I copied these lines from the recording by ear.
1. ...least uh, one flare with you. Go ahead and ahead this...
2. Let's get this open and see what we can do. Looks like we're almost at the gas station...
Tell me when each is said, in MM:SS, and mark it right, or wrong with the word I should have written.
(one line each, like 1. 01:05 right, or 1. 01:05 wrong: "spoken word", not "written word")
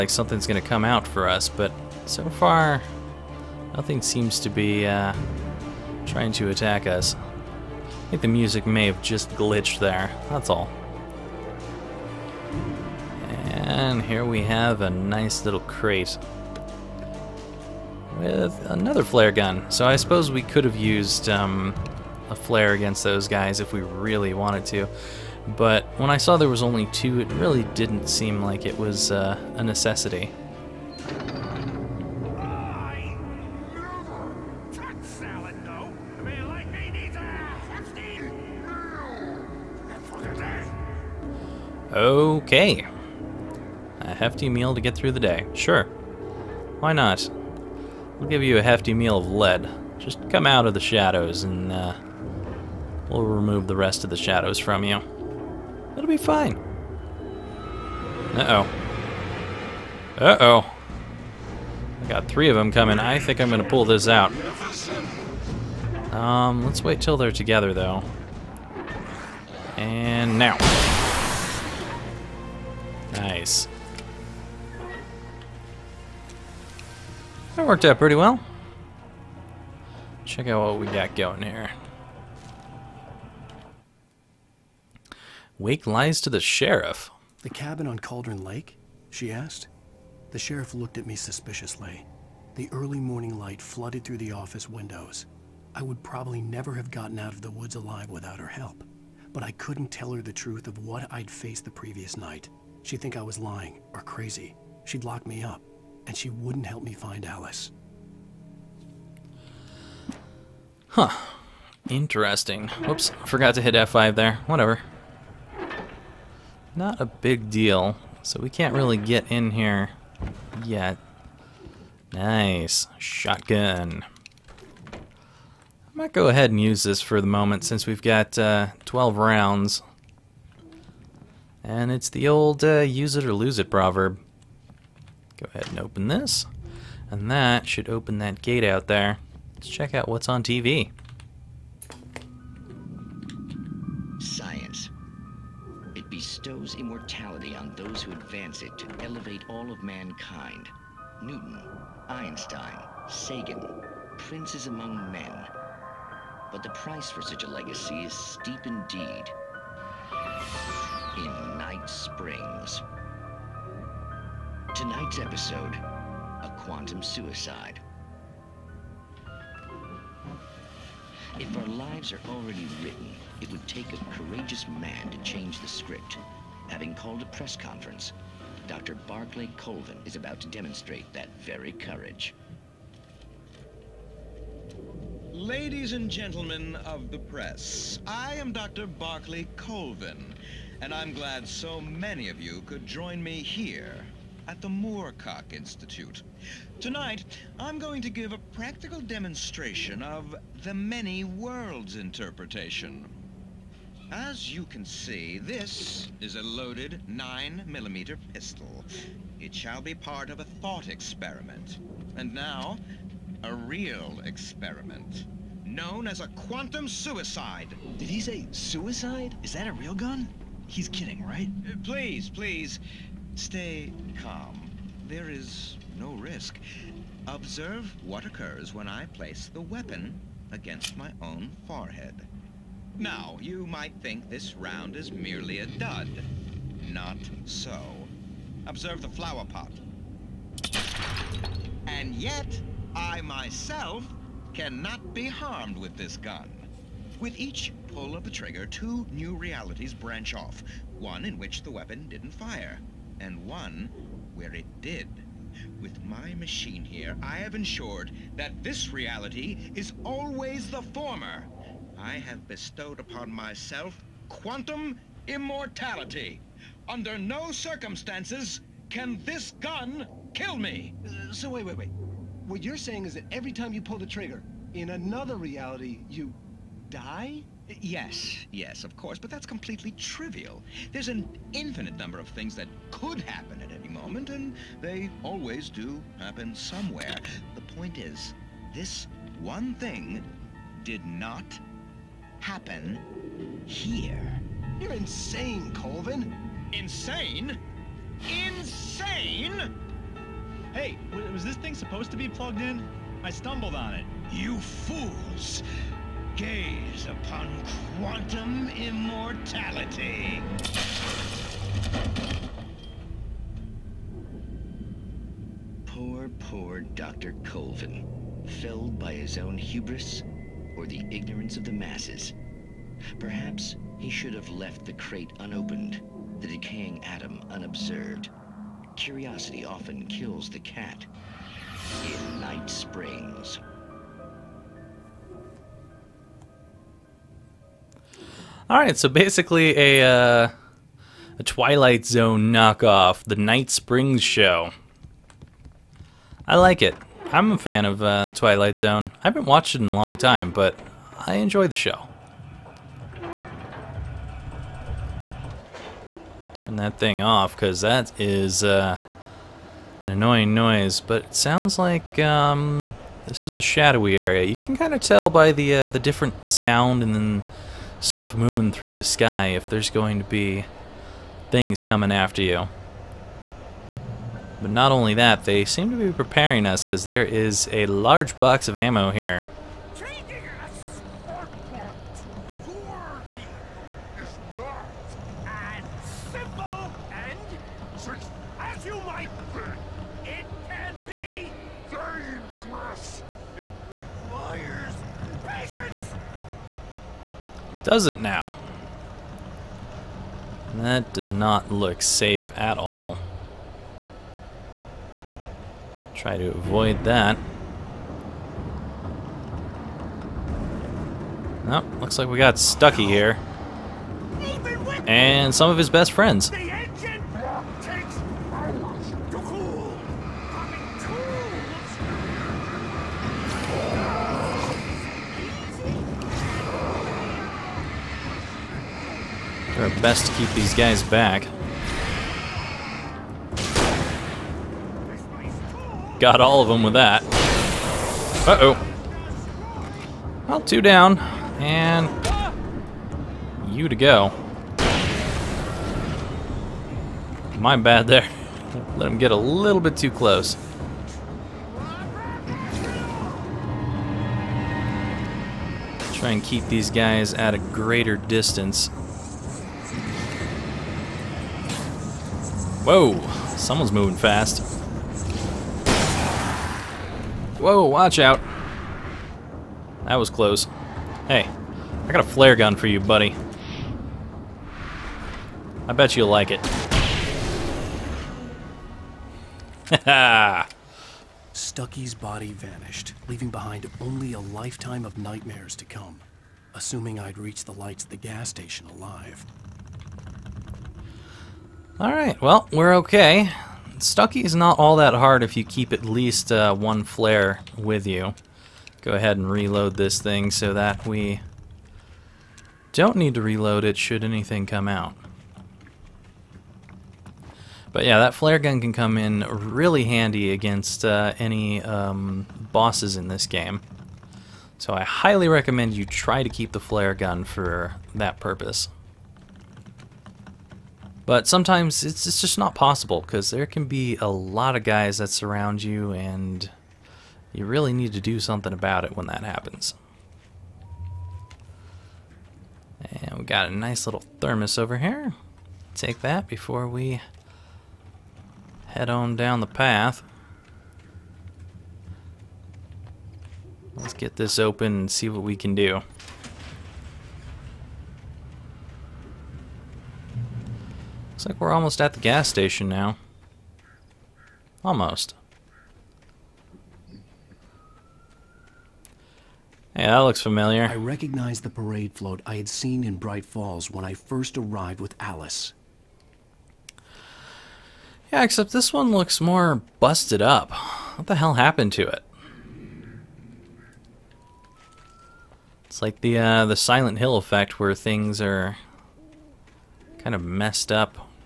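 1. 08:16 wrong: "reload", not "ahead"
2. 09:03 right.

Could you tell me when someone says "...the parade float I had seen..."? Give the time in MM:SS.
09:21.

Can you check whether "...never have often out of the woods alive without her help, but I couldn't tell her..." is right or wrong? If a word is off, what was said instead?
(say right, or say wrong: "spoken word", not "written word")
wrong: "gotten", not "often".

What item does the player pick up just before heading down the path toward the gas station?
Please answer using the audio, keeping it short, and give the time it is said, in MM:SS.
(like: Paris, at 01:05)
thermos, at 08:54.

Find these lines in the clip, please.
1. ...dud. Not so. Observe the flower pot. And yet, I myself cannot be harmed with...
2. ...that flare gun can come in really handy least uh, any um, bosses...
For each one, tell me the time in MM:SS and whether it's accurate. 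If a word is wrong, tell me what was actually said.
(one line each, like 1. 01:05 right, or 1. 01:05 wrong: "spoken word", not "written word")
1. 03:55 right
2. 08:28 wrong: "against", not "least".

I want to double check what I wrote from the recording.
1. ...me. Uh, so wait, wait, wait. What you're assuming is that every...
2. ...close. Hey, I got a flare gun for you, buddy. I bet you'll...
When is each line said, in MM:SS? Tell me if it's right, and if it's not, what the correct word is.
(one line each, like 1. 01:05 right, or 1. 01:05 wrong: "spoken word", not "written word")
1. 04:30 wrong: "saying", not "assuming"
2. 07:50 right.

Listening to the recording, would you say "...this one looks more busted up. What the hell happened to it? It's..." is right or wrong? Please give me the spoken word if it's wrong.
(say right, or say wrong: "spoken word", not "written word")
right.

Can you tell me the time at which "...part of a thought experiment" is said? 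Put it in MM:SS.
03:29.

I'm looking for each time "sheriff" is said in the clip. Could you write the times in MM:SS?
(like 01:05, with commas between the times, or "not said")
01:26, 01:30.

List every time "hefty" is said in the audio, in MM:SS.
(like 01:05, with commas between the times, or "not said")
00:44, 00:48.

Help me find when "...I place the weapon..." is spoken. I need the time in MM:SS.
03:48.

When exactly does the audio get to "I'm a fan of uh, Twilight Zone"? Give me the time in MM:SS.
05:47.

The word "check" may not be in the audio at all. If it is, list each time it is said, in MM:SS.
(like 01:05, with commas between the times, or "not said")
01:20, 02:19.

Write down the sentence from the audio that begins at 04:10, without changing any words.
One in which the weapon didn't fire, and one where it did.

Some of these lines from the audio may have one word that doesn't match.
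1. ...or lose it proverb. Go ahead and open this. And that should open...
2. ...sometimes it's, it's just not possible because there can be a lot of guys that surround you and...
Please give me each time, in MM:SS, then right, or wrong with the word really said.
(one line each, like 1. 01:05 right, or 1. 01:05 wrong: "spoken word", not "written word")
1. 02:13 right
2. 08:41 right.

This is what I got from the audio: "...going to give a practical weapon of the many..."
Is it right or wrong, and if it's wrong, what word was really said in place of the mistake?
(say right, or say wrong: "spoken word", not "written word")
wrong: "demonstration", not "weapon".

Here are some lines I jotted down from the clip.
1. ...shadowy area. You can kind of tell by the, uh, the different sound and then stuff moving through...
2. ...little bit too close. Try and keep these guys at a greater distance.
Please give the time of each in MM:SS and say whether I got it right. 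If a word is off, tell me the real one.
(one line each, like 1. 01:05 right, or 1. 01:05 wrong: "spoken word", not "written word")
1. 06:03 right
2. 07:29 right.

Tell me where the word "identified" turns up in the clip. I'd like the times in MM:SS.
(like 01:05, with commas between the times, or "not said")
not said.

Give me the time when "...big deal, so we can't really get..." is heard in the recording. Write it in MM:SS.
01:57.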